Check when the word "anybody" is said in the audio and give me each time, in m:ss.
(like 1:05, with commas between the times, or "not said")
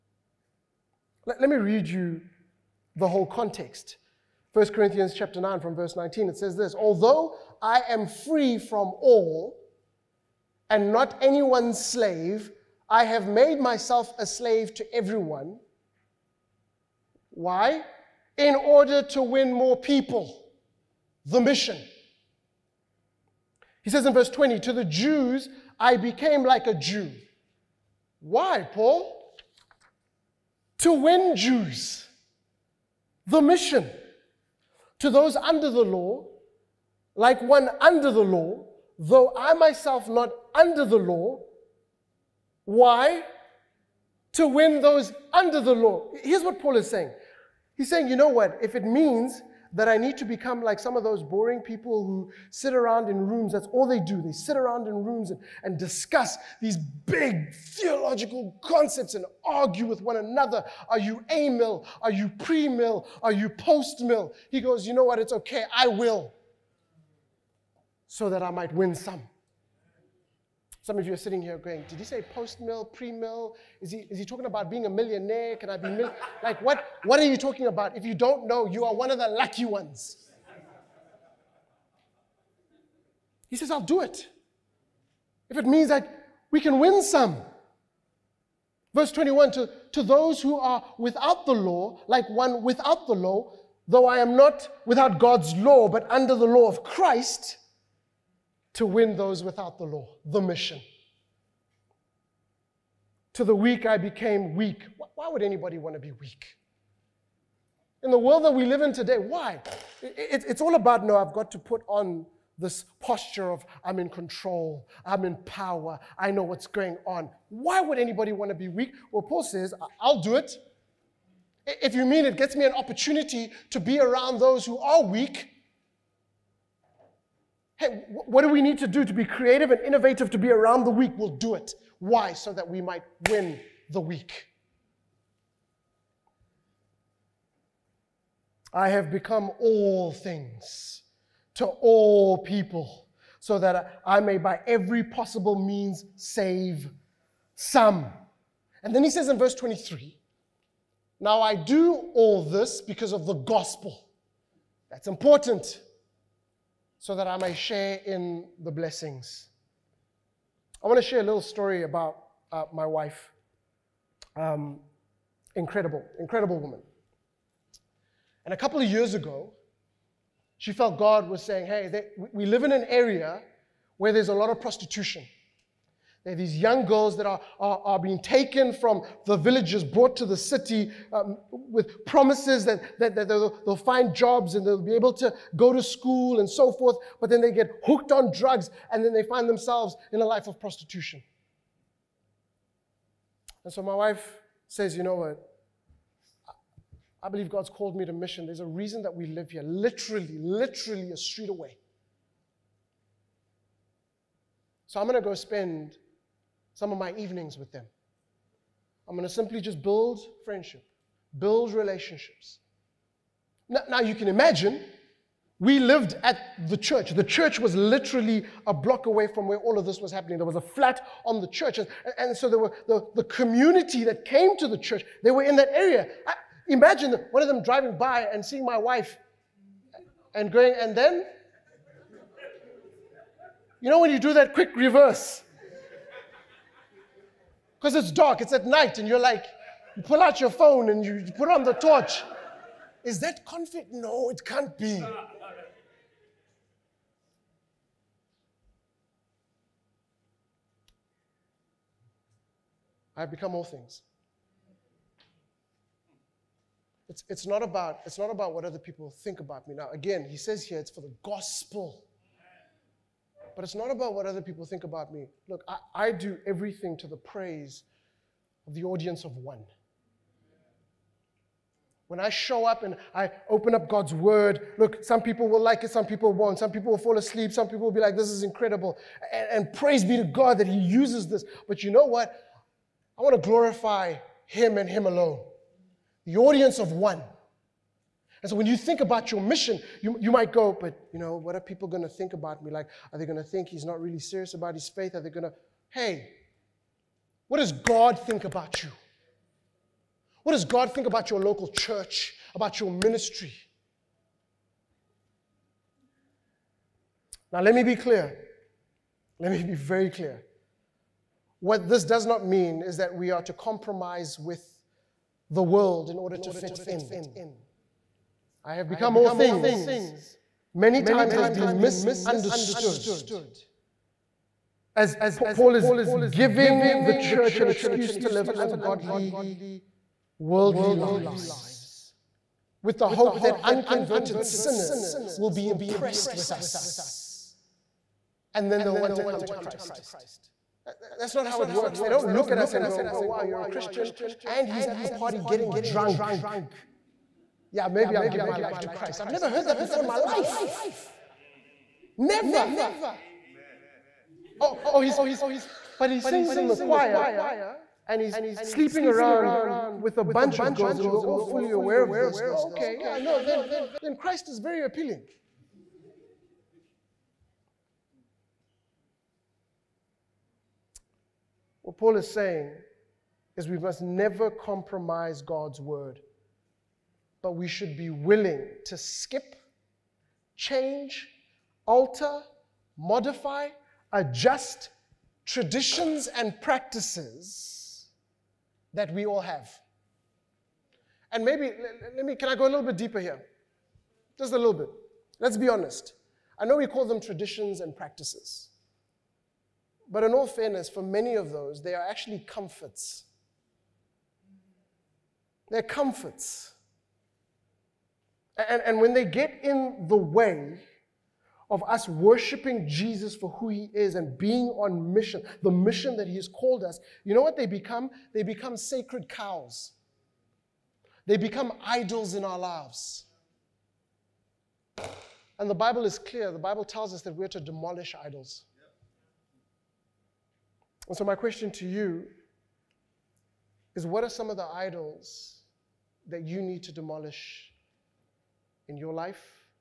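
1:45, 1:57.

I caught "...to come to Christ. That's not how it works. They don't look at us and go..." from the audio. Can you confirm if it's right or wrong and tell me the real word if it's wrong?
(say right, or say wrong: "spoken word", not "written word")
right.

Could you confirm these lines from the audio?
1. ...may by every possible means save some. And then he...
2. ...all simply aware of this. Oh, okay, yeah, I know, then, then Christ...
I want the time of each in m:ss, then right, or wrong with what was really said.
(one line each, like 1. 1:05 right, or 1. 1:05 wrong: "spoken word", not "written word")
1. 2:24 right
2. 6:01 wrong: "fully", not "simply".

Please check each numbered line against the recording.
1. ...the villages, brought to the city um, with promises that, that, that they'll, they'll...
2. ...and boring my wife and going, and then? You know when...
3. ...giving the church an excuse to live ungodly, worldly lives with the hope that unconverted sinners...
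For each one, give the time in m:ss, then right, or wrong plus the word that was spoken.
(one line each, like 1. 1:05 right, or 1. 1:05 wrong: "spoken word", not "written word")
1. 2:59 right
2. 3:48 wrong: "seeing", not "boring"
3. 5:26 right.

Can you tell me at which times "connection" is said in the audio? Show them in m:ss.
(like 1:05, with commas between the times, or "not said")
not said.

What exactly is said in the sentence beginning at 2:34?
That's important so that I may share in the blessings.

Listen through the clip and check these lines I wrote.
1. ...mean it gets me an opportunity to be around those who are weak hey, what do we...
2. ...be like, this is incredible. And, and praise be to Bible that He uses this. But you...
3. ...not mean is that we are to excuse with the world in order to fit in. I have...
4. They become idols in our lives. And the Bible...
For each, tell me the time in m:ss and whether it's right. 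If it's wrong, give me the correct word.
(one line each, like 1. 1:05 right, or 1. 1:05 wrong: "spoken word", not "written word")
1. 2:02 right
2. 4:37 wrong: "God", not "Bible"
3. 5:12 wrong: "compromise", not "excuse"
4. 7:01 right.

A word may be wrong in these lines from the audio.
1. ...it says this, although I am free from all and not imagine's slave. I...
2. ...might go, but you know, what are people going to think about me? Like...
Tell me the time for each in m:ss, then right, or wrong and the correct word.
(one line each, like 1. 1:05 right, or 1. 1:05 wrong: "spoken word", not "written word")
1. 0:06 wrong: "anyone", not "imagine"
2. 4:50 right.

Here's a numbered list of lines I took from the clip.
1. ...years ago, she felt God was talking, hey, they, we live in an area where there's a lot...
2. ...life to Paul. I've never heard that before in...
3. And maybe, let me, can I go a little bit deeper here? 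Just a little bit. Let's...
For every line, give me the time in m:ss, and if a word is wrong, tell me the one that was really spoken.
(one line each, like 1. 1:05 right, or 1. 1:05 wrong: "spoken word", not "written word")
1. 2:48 wrong: "saying", not "talking"
2. 5:48 wrong: "Christ", not "Paul"
3. 6:31 right.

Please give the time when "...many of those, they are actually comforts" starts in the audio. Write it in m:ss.
6:41.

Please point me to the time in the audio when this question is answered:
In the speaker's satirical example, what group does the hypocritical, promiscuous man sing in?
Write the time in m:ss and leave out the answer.
5:56.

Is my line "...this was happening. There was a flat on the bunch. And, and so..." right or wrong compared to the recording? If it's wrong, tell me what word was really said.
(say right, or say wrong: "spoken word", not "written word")
wrong: "church", not "bunch".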